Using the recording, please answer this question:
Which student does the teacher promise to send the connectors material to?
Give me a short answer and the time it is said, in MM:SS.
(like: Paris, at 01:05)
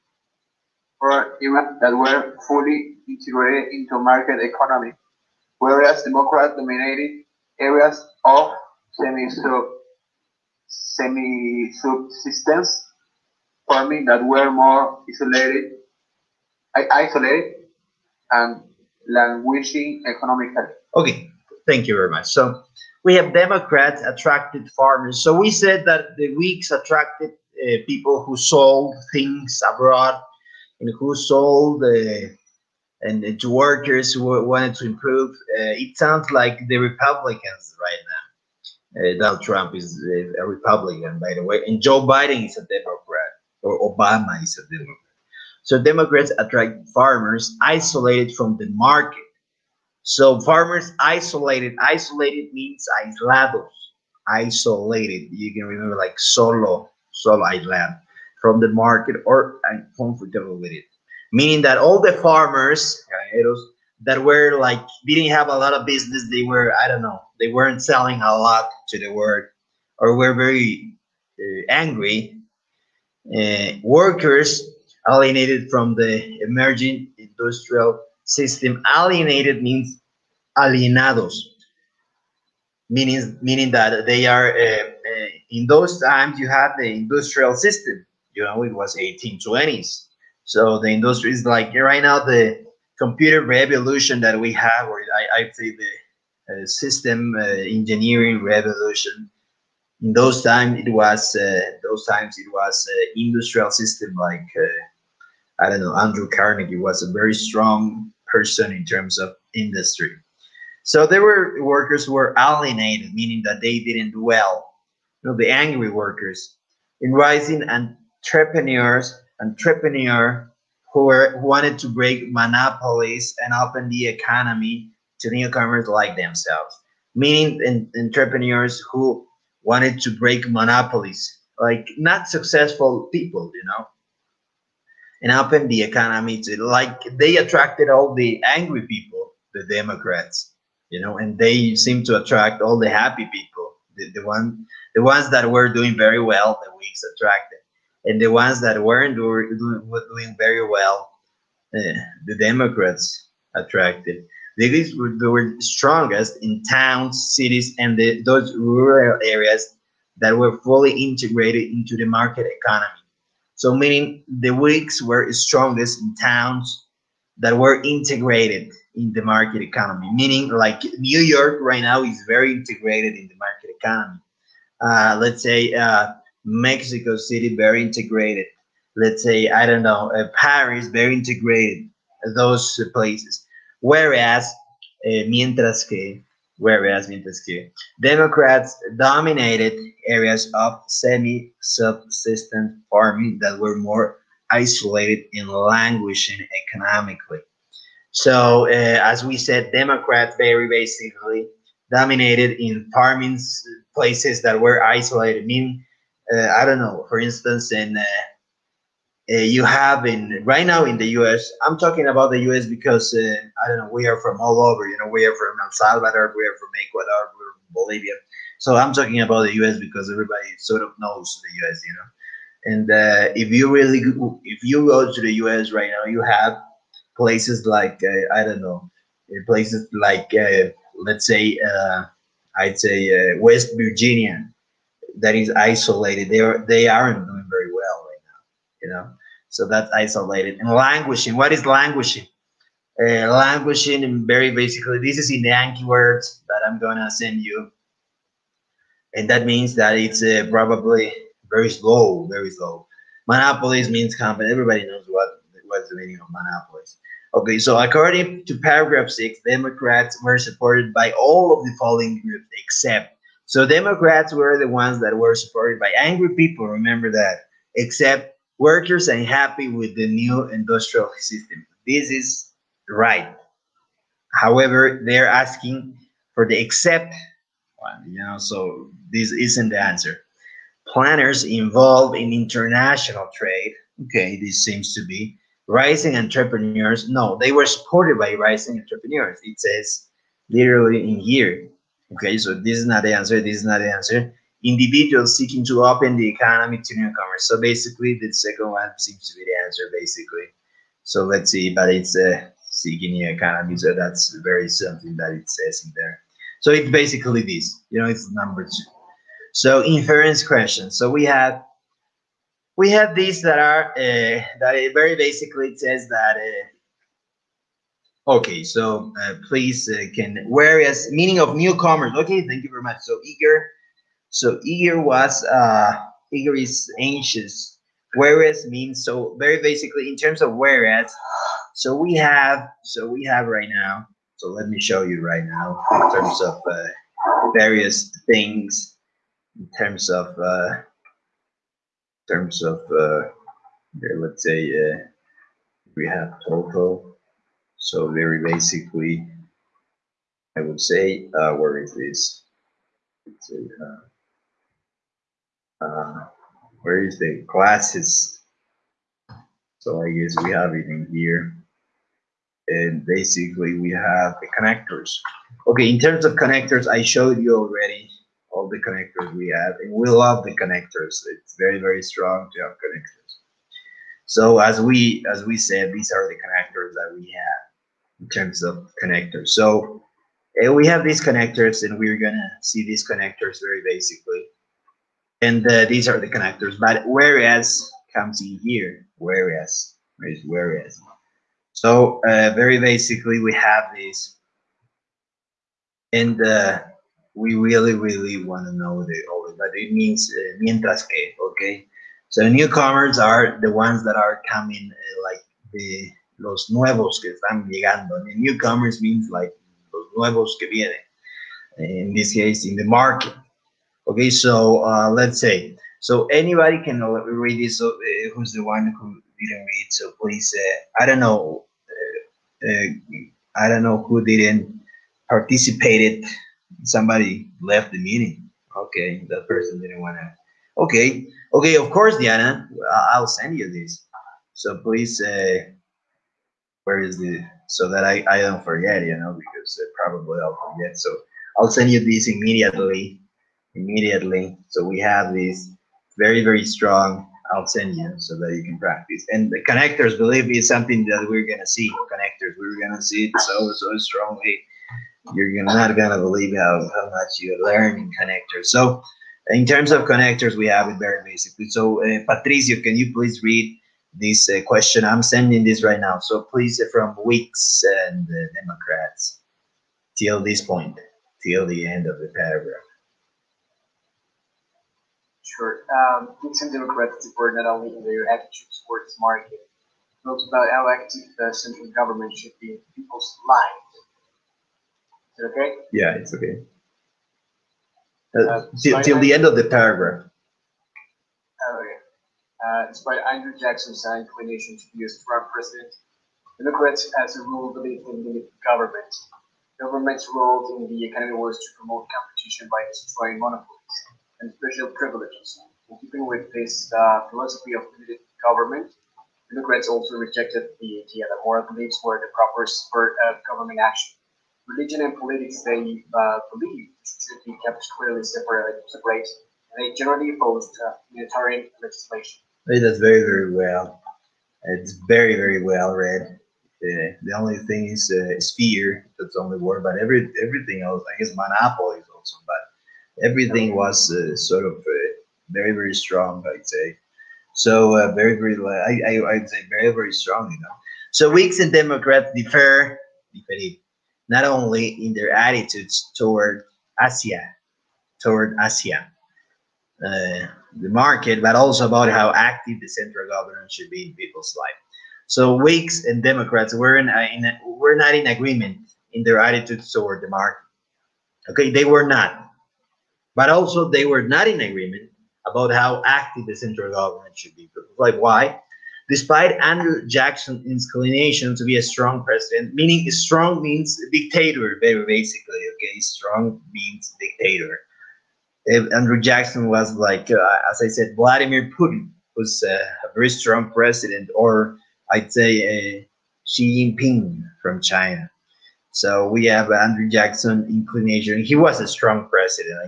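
Diana, at 07:12.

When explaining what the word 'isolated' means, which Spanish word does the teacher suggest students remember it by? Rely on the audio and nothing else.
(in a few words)
solo.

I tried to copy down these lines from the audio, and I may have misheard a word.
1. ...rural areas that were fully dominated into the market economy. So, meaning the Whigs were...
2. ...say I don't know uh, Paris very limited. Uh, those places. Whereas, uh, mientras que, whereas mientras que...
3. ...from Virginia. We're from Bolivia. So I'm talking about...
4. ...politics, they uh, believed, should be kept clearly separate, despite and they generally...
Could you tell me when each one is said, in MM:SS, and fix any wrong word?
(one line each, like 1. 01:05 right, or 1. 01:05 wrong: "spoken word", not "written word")
1. 02:38 wrong: "integrated", not "dominated"
2. 02:59 wrong: "integrated", not "limited"
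3. 03:36 wrong: "Ecuador", not "Virginia"
4. 08:35 wrong: "separate", not "despite".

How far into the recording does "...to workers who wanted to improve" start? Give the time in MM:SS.
00:33.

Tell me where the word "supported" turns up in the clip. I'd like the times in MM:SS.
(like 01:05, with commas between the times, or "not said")
04:20, 04:25, 04:47.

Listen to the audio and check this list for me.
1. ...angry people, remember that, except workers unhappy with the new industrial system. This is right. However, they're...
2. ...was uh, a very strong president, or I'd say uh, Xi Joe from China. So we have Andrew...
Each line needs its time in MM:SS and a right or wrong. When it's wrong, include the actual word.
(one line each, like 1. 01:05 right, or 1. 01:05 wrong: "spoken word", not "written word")
1. 04:25 right
2. 09:42 wrong: "Jinping", not "Joe".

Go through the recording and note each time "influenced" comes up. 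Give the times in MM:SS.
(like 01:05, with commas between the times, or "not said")
not said.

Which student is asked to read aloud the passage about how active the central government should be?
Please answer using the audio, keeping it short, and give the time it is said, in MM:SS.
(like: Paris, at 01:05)
Patricio, at 07:42.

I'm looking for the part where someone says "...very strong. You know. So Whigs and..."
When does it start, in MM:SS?
08:59.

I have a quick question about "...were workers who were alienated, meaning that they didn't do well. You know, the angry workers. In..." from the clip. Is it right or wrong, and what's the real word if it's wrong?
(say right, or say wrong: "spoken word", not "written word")
right.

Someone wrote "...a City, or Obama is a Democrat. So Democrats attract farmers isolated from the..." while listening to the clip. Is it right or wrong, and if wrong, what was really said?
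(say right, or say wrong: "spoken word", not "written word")
wrong: "Democrat", not "City".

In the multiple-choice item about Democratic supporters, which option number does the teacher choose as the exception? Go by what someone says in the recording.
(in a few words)
2.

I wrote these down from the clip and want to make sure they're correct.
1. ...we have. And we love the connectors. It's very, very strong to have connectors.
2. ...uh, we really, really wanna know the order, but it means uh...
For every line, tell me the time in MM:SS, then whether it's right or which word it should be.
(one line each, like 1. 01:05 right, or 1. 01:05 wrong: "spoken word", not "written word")
1. 06:09 right
2. 06:36 right.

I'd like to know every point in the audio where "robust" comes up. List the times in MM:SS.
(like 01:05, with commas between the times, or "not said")
not said.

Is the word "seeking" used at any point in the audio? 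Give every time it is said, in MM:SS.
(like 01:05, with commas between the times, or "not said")
04:55, 05:02.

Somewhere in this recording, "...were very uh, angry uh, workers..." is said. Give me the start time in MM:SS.
01:10.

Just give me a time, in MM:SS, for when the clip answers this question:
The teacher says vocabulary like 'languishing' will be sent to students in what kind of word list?
04:05.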